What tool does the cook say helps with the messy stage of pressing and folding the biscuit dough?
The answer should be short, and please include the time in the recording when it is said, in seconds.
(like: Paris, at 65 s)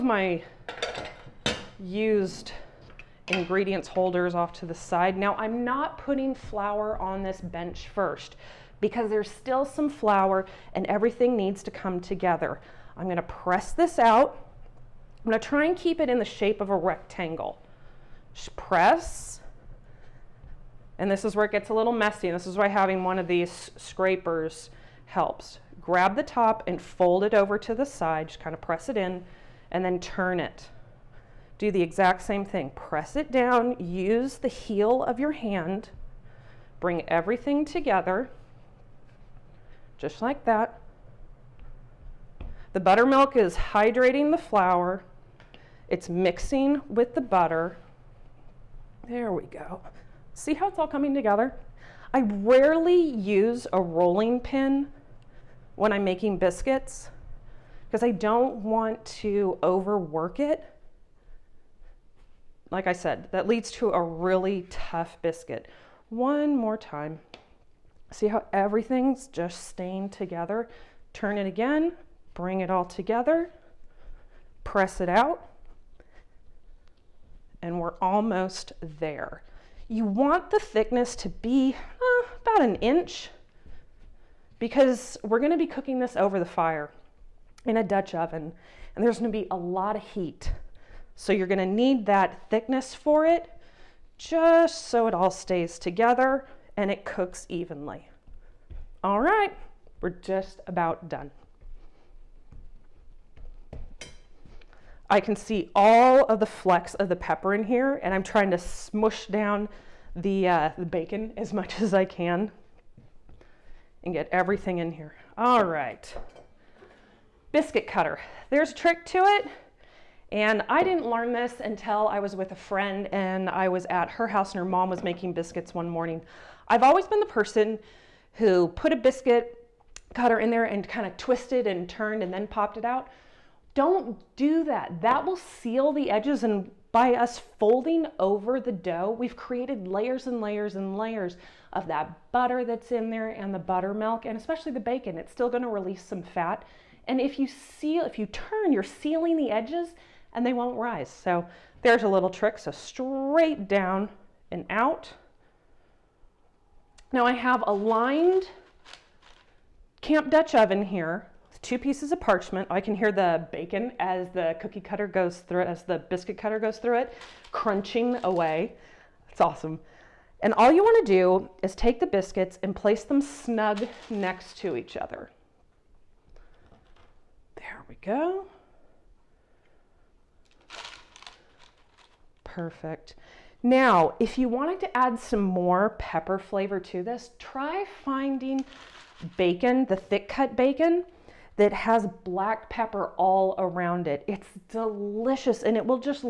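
scrapers, at 23 s.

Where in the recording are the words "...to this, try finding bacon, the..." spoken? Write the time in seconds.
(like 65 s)
186 s.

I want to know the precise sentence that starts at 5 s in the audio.
Now I'm not putting flour on this bench first because there's still some flour and everything needs to come together.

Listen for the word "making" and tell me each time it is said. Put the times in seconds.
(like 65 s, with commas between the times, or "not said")
56 s, 125 s.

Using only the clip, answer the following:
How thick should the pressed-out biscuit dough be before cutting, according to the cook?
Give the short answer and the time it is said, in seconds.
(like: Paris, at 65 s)
about 1 inch, at 82 s.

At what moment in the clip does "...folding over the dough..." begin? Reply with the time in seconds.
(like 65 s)
137 s.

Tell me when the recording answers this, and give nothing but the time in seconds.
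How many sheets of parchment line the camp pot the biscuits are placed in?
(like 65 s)
161 s.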